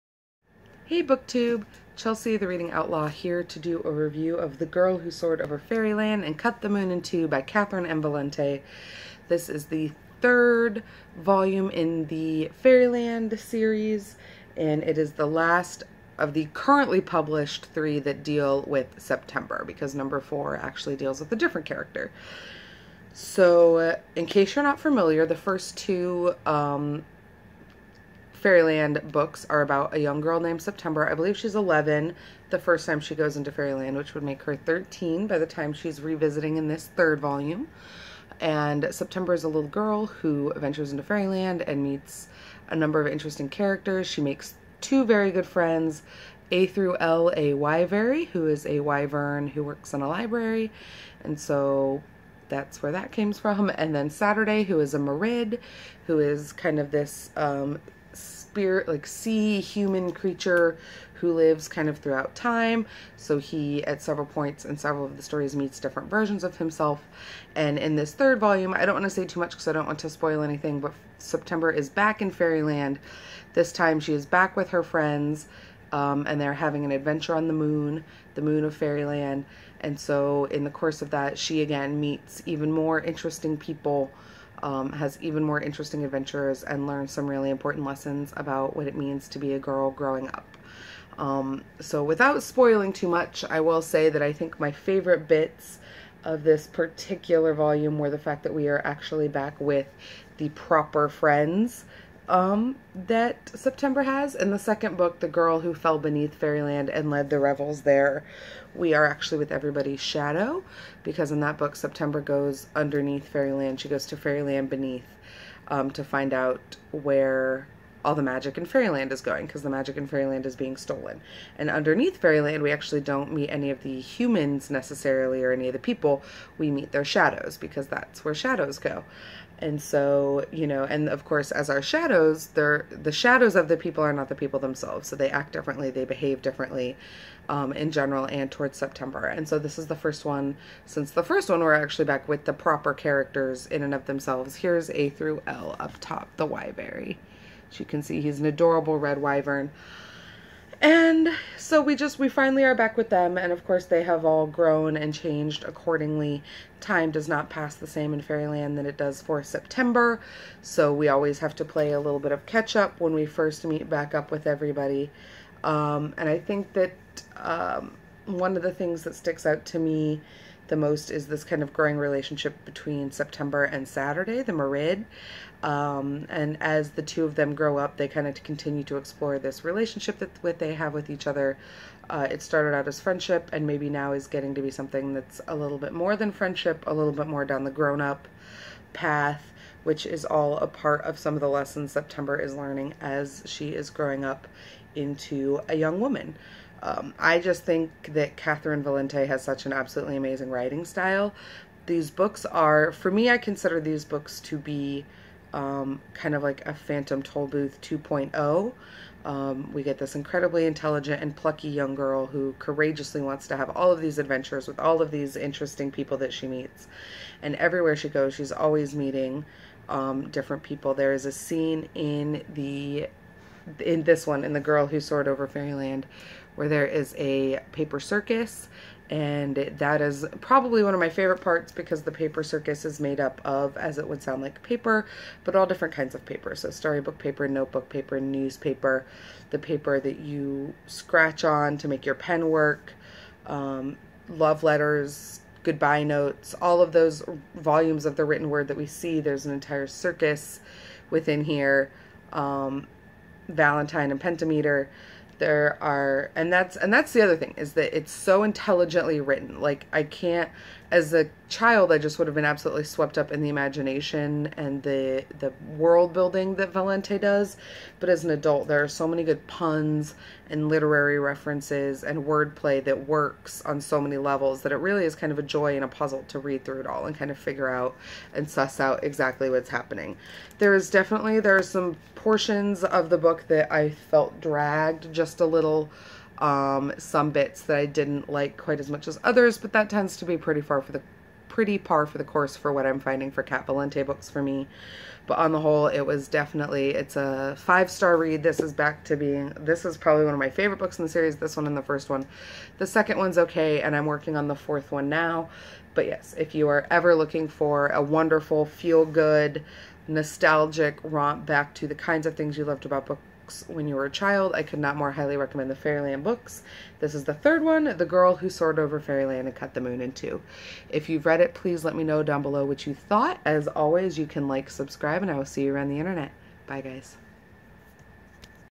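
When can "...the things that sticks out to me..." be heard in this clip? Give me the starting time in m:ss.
2:48.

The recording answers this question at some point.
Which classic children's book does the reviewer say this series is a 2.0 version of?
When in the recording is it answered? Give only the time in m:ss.
3:26.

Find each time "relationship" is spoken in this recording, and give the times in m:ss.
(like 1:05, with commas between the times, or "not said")
2:51, 2:59.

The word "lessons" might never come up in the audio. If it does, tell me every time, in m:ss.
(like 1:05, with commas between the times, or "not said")
1:27, 3:11.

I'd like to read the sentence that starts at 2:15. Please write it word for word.
So they act differently, they behave differently um, in general and towards September.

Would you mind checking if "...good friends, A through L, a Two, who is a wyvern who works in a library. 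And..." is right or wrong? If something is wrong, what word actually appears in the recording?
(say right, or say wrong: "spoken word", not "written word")
wrong: "Wyverary", not "Two".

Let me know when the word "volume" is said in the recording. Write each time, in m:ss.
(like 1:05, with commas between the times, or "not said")
0:11, 0:37, 1:08, 1:37, 4:07.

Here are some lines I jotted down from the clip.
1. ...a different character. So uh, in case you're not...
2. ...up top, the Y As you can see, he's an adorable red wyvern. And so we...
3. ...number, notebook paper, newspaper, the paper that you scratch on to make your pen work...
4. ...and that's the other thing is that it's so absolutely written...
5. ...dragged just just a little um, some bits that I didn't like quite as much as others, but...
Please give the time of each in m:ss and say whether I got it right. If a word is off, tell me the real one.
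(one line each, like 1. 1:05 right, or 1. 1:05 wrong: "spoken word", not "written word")
1. 0:21 right
2. 2:25 right
3. 3:57 wrong: "paper", not "number"
4. 4:16 wrong: "intelligently", not "absolutely"
5. 4:44 right.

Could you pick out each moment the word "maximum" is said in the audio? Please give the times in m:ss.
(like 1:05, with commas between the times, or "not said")
not said.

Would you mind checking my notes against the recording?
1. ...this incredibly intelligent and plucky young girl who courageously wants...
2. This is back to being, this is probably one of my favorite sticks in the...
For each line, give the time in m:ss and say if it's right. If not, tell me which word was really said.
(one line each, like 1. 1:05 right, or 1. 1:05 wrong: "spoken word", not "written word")
1. 3:29 right
2. 4:58 wrong: "books", not "sticks".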